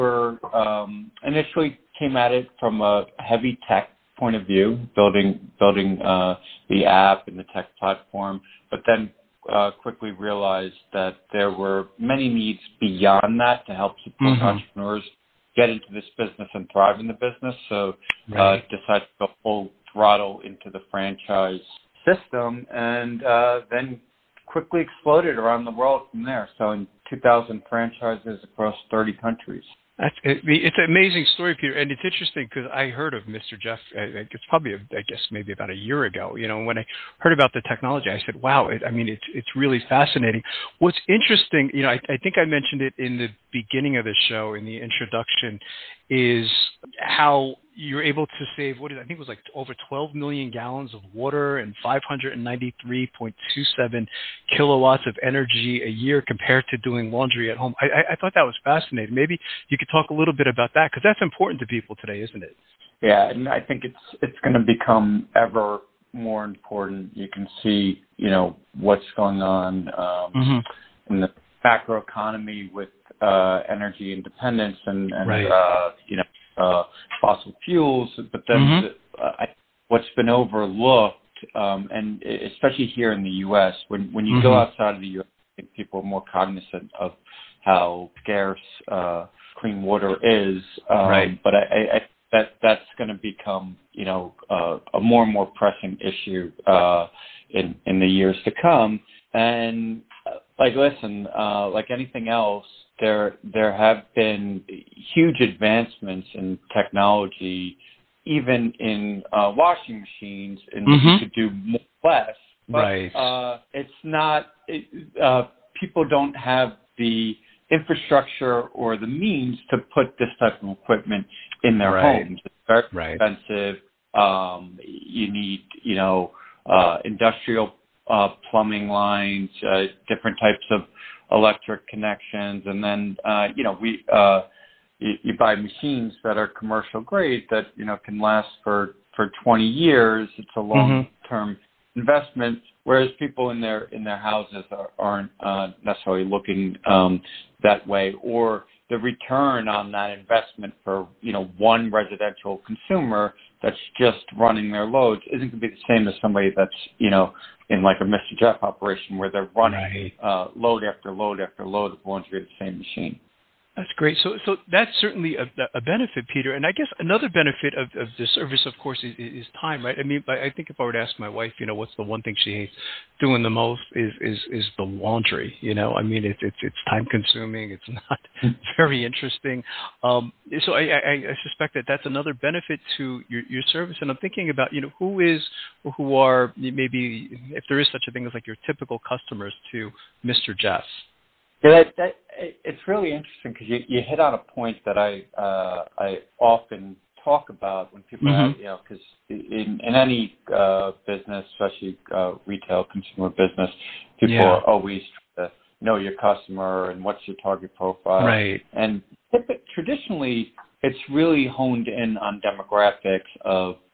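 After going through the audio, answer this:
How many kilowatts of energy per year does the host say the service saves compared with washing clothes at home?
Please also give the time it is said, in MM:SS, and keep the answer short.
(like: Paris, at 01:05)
593.27, at 00:51.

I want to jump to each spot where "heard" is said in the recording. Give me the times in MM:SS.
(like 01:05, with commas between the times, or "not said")
00:32, 00:37.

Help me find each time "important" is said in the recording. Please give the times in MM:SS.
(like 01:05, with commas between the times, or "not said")
01:01, 01:06.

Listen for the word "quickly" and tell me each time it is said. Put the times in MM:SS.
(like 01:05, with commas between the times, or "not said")
00:09, 00:24.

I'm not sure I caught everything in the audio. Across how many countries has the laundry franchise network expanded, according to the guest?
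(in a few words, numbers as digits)
30.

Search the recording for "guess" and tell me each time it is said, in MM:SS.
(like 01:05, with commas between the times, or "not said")
00:35, 02:46.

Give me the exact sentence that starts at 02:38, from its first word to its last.
Jeff operation where they're running right.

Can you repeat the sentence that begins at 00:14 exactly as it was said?
entrepreneurs get into this business and thrive in the business.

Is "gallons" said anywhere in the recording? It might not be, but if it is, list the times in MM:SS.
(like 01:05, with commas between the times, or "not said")
00:50.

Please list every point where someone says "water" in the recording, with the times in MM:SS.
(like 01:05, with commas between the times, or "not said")
00:51, 01:29.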